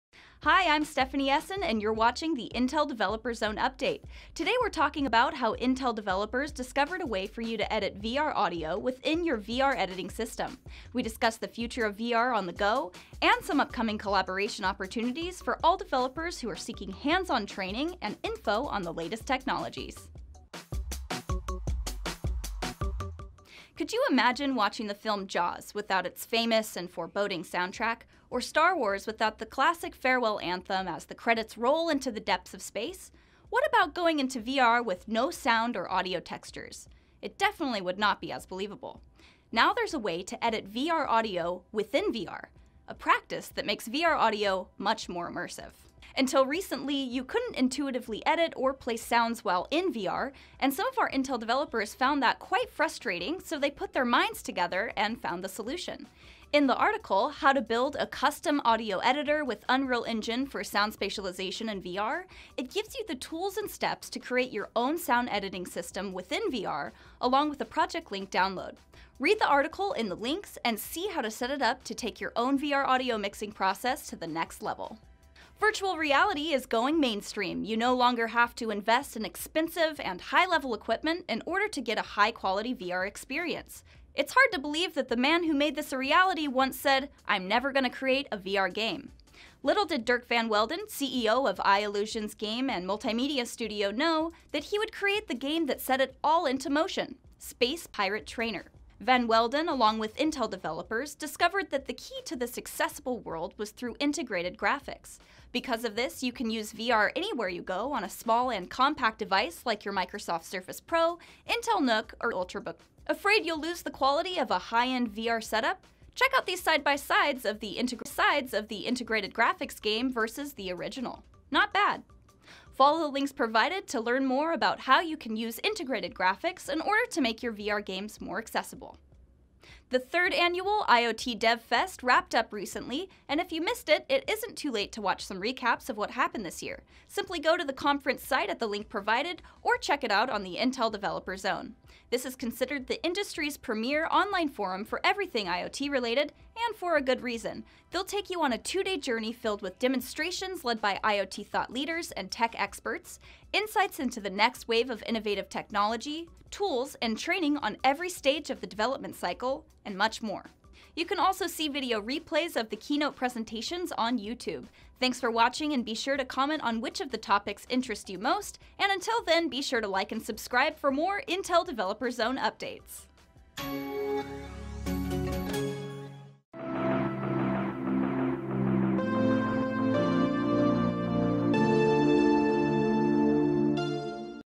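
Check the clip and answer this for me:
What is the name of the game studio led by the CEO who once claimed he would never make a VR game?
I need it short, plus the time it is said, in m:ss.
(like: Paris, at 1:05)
I-Illusions, at 1:31.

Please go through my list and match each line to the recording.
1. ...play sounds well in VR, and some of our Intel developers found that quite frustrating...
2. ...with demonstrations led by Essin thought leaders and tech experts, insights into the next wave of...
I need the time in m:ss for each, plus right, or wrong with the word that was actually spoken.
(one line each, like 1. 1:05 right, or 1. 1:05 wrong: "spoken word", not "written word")
1. 0:48 right
2. 2:29 wrong: "IoT", not "Essin".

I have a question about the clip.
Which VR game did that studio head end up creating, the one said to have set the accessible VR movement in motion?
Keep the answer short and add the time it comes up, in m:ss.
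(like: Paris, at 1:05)
Space Pirate Trainer, at 1:37.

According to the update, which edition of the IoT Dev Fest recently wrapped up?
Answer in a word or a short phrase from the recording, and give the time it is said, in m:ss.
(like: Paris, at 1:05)
third, at 2:09.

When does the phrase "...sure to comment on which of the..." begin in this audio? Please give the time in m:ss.
2:45.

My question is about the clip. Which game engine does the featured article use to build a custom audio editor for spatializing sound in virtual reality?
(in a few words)
Unreal Engine.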